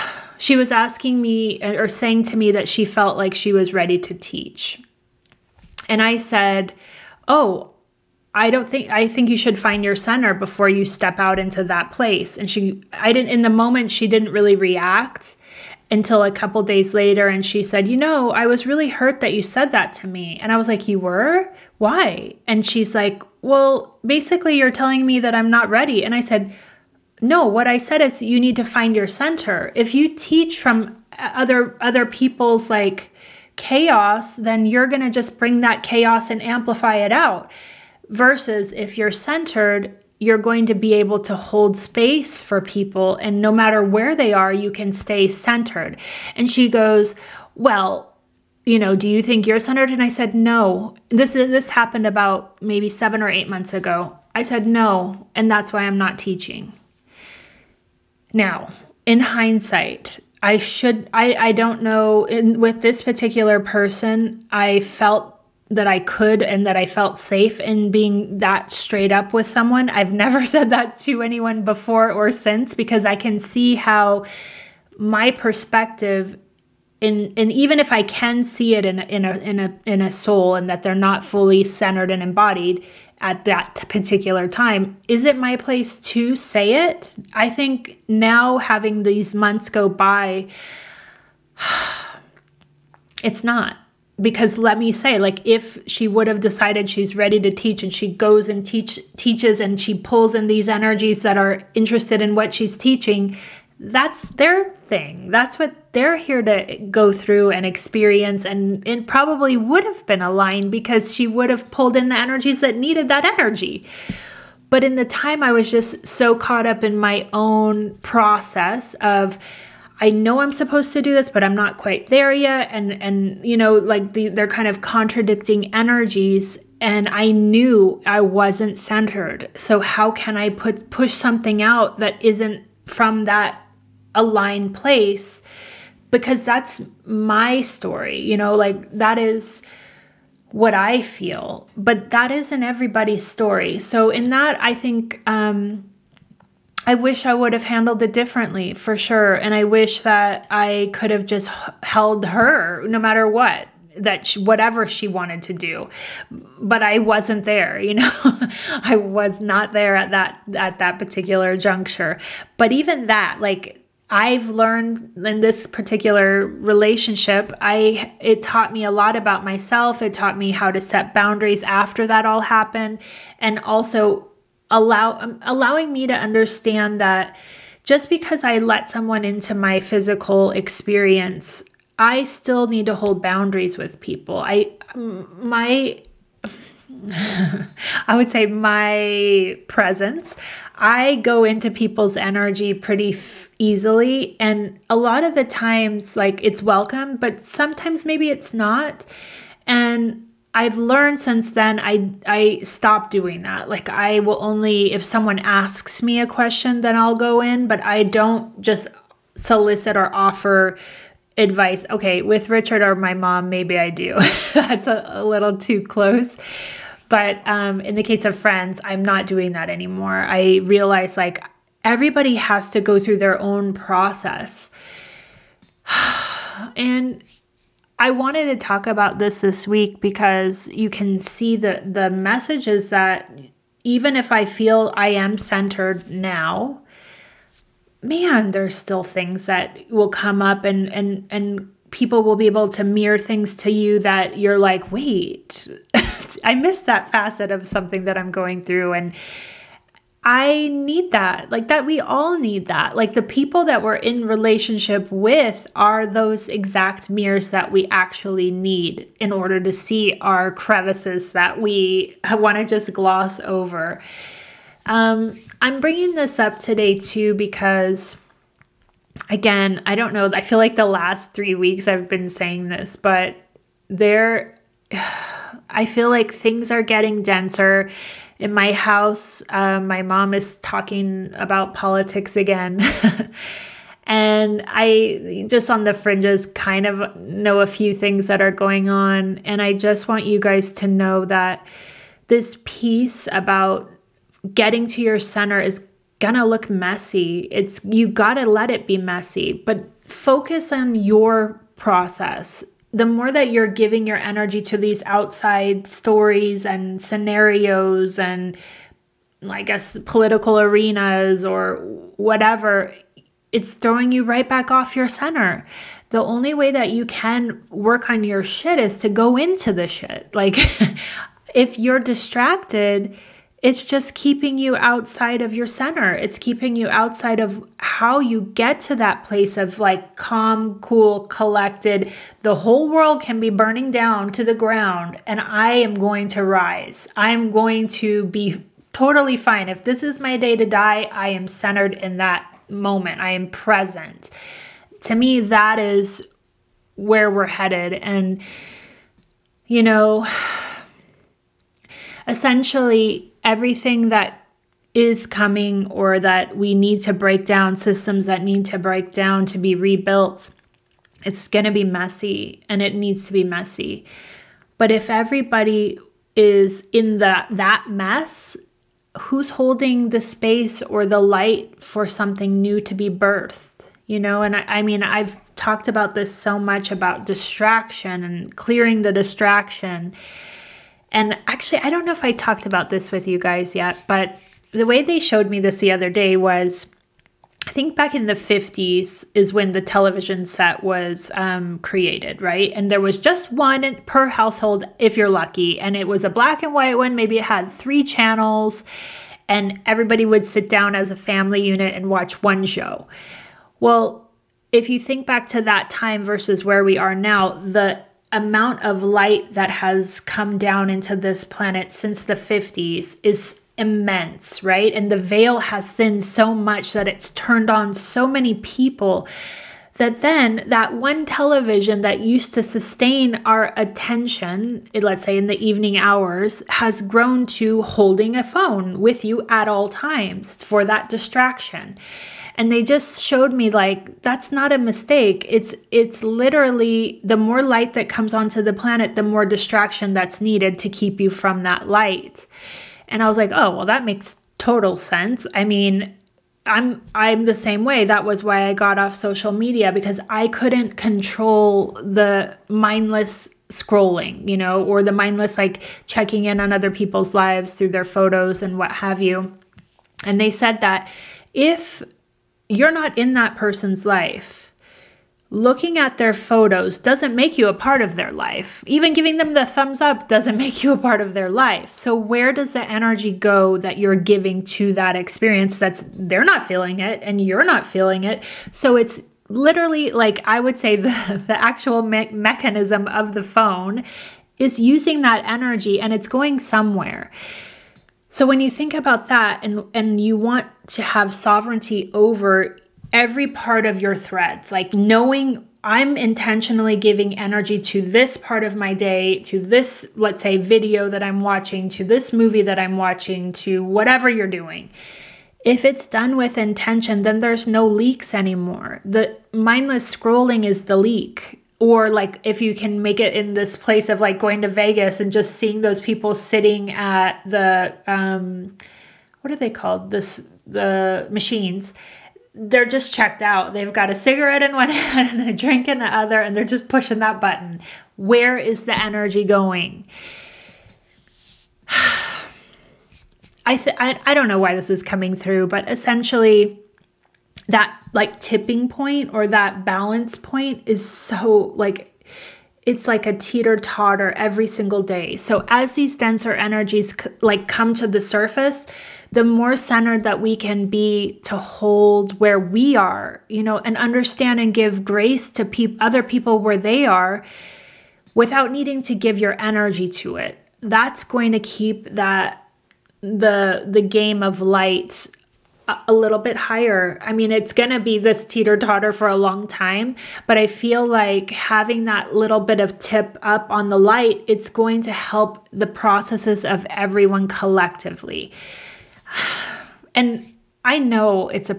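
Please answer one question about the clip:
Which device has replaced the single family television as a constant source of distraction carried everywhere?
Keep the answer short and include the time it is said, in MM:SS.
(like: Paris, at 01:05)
A phone, at 07:08.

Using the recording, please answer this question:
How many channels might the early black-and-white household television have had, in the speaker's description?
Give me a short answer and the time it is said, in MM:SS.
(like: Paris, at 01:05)
3, at 06:37.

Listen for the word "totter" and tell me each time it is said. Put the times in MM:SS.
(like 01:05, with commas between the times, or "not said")
09:03, 09:28.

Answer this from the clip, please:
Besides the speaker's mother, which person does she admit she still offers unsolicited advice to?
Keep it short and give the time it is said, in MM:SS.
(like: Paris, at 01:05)
Richard, at 03:32.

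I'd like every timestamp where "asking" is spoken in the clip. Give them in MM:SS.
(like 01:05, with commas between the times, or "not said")
00:00.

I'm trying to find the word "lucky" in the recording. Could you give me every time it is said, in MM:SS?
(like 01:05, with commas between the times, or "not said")
06:35.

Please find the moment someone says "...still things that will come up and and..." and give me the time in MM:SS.
03:58.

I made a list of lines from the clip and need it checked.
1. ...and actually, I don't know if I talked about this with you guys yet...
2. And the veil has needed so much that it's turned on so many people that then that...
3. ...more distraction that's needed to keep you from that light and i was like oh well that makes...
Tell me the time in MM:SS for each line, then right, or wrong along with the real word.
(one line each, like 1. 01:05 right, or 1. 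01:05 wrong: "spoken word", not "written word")
1. 06:21 right
2. 06:54 wrong: "thinned", not "needed"
3. 07:19 right.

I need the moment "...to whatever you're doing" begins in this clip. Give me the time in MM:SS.
08:23.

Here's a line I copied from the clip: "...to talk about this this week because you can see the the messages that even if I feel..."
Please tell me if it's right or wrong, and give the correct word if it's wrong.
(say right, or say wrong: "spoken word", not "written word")
right.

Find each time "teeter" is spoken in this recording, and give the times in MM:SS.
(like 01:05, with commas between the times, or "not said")
09:03, 09:28.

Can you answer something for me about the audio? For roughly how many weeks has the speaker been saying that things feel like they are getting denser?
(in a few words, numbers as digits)
3 weeks.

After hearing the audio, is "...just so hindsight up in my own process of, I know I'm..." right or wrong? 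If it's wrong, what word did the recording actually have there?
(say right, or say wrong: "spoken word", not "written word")
wrong: "caught", not "hindsight".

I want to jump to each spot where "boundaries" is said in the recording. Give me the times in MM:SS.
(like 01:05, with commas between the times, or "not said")
02:51, 03:03.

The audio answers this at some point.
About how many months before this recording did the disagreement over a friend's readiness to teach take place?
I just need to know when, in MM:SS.
00:52.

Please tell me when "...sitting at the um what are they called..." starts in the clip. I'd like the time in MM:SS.
08:36.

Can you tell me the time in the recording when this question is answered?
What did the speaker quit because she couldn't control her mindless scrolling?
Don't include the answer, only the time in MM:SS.
07:29.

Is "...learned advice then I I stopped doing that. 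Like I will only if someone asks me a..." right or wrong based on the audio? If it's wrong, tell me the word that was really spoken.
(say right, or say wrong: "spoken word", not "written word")
wrong: "since", not "advice".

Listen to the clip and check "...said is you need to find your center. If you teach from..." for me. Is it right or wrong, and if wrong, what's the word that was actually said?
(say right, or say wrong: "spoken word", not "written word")
right.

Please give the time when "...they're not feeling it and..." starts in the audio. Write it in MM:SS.
07:56.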